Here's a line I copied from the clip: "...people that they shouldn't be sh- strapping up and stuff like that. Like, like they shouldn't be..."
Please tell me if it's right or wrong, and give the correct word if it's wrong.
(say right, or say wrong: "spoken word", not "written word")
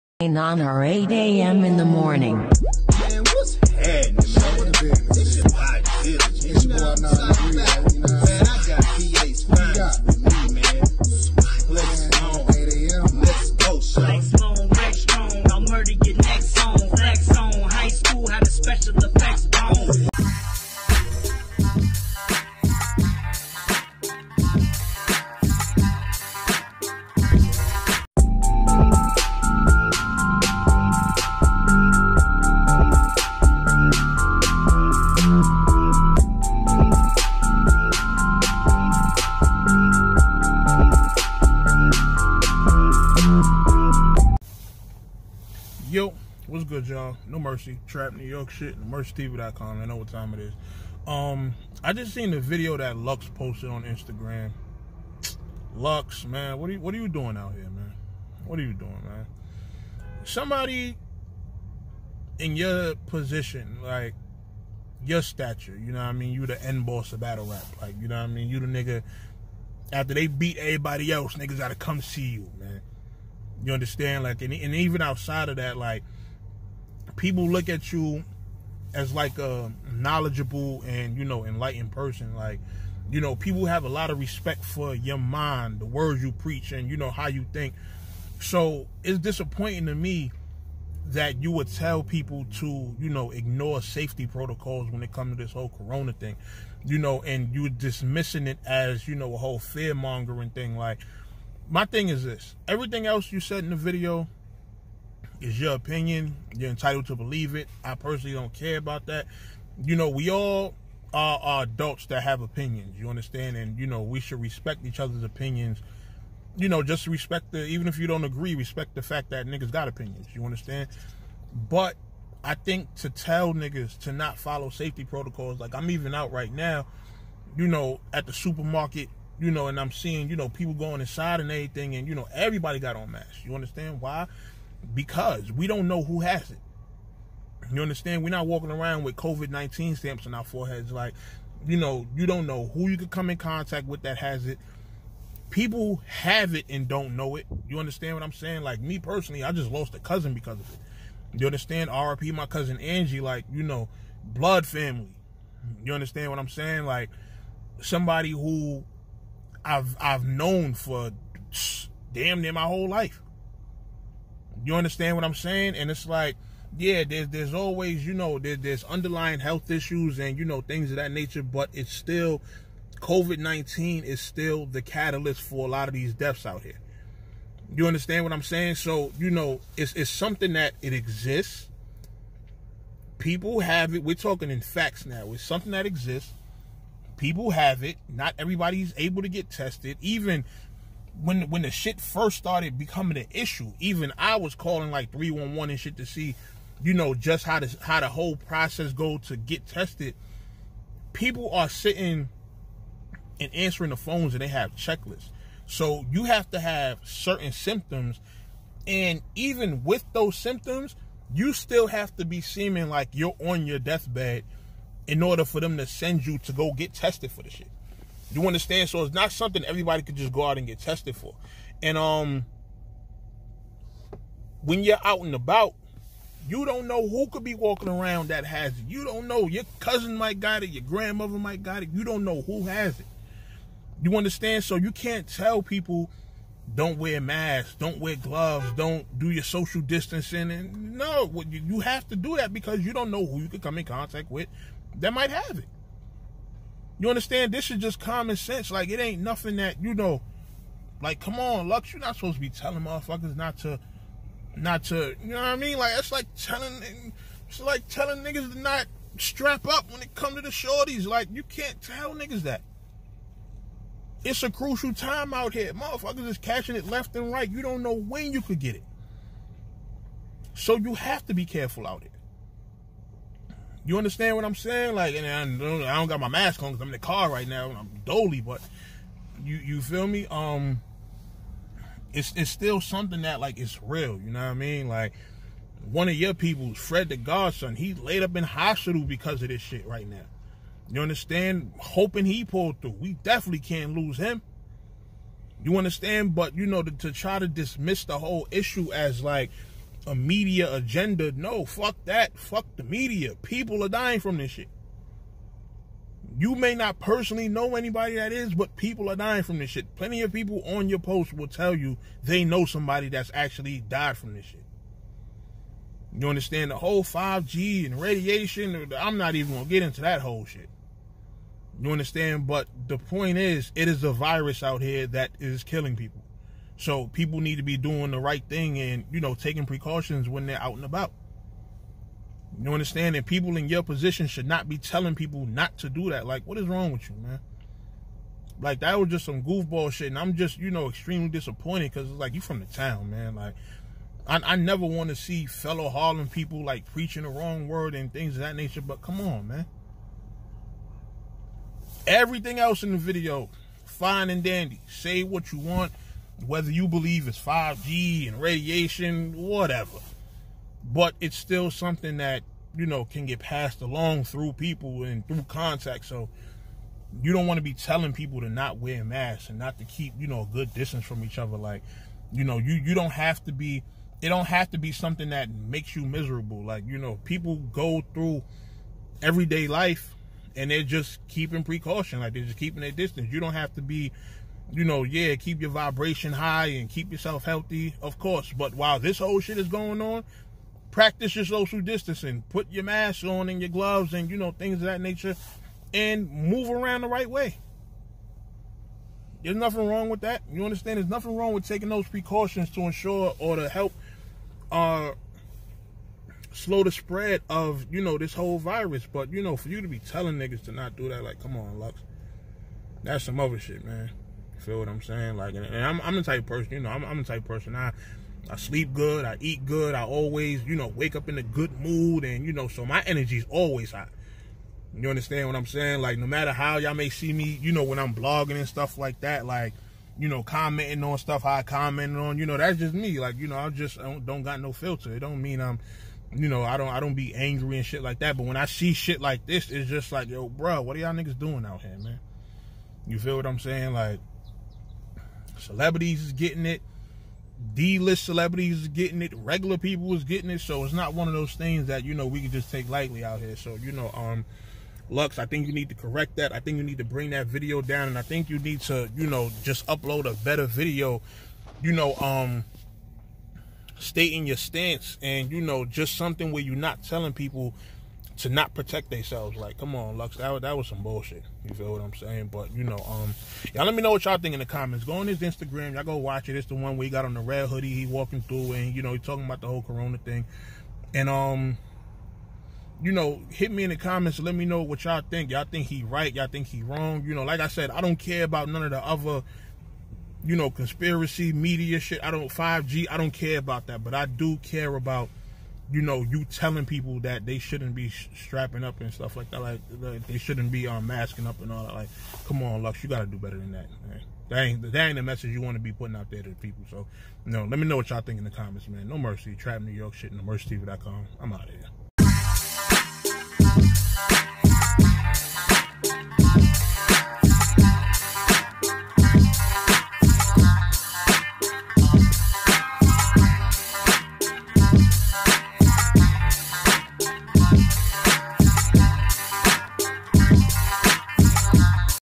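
right.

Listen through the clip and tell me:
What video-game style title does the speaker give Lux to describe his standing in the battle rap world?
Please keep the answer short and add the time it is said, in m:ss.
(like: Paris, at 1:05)
end boss, at 1:06.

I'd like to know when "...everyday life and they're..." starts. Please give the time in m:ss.
6:19.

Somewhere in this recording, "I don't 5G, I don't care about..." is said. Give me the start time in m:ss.
8:12.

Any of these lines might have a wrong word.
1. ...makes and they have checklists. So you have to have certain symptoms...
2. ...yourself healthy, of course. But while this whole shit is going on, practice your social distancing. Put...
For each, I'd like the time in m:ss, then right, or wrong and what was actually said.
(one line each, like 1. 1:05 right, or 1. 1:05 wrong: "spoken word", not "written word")
1. 3:23 wrong: "phones", not "makes"
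2. 6:27 right.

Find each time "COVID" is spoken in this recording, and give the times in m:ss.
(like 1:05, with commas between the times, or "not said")
2:19, 2:53.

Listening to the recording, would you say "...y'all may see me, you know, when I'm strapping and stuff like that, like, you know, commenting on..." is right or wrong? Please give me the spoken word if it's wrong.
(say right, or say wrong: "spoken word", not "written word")
wrong: "blogging", not "strapping".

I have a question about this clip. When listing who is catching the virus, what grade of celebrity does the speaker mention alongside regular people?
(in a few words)
D-list.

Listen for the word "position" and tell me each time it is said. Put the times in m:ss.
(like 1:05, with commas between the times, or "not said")
1:03, 5:33.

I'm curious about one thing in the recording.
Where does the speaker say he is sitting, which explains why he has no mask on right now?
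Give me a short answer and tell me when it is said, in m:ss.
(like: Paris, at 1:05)
in the car, at 4:36.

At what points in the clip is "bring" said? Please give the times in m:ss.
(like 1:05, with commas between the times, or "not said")
7:37.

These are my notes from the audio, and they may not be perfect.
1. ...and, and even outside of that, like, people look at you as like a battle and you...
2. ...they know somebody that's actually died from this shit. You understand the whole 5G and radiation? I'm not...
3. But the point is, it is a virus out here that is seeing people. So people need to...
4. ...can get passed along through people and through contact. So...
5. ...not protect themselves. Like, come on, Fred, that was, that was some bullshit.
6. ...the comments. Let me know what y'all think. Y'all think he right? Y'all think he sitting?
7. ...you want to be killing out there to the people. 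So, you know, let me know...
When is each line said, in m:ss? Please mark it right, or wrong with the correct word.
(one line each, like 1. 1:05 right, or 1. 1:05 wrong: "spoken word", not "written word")
1. 1:14 wrong: "knowledgeable", not "battle"
2. 5:12 right
3. 5:22 wrong: "killing", not "seeing"
4. 6:03 right
5. 7:48 wrong: "Lux", not "Fred"
6. 8:03 wrong: "wrong", not "sitting"
7. 8:25 wrong: "putting", not "killing".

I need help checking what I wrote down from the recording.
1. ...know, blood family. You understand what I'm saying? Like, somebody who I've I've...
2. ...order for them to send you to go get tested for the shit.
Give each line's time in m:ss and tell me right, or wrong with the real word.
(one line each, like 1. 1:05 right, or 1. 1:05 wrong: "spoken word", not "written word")
1. 2:33 right
2. 3:35 right.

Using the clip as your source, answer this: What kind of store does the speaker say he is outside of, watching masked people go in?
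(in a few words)
supermarket.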